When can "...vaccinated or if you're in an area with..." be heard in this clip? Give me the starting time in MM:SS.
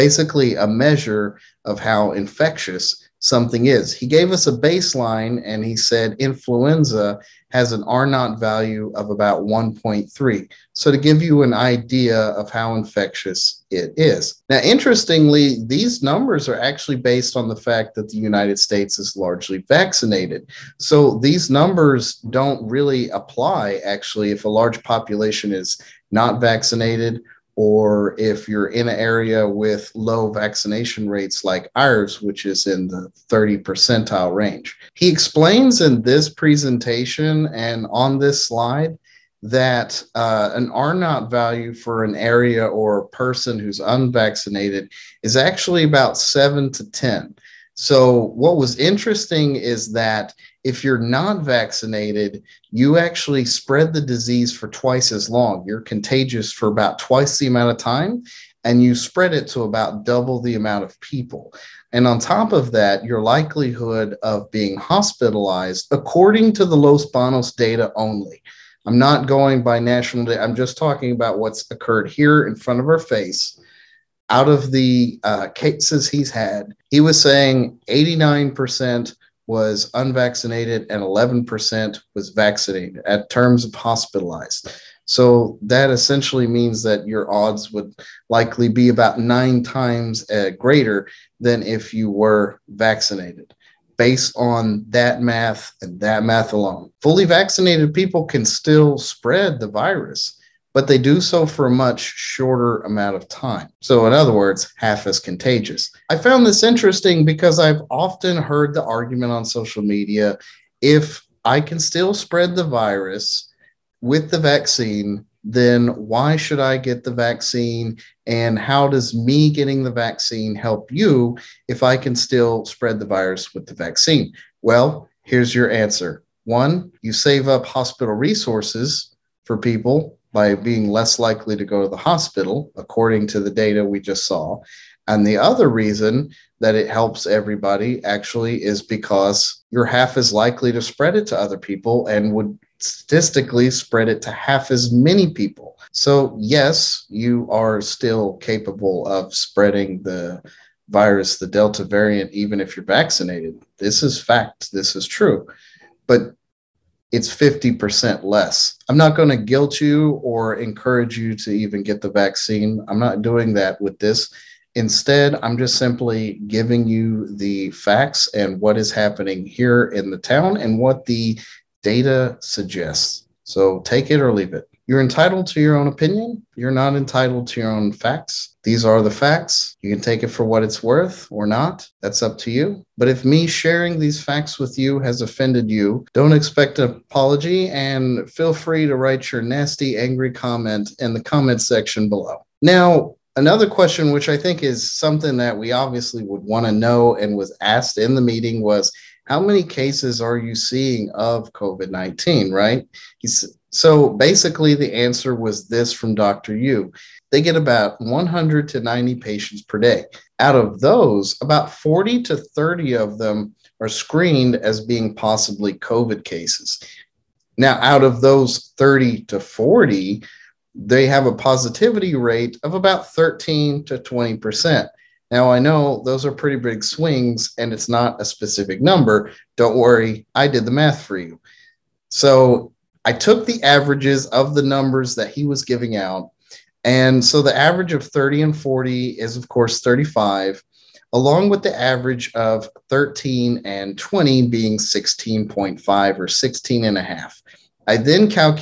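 00:26.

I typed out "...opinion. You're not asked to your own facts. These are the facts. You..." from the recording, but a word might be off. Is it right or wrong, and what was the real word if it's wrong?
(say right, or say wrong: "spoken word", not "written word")
wrong: "entitled", not "asked".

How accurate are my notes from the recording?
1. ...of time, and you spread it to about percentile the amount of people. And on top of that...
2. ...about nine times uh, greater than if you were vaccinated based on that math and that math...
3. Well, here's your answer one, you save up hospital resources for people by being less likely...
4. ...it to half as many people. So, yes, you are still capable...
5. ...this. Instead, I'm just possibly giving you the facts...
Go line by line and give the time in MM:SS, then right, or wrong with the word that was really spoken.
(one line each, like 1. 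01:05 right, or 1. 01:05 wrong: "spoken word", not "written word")
1. 00:57 wrong: "double", not "percentile"
2. 01:28 right
3. 02:04 right
4. 02:24 right
5. 02:43 wrong: "simply", not "possibly".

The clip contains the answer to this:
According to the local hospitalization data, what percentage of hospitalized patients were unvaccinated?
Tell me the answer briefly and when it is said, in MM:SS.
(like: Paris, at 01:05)
89%, at 01:17.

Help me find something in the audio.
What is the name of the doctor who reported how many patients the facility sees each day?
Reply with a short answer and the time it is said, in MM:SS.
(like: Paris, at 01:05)
Dr. Yu, at 03:26.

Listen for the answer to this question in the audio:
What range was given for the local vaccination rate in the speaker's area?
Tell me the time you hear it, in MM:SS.
00:33.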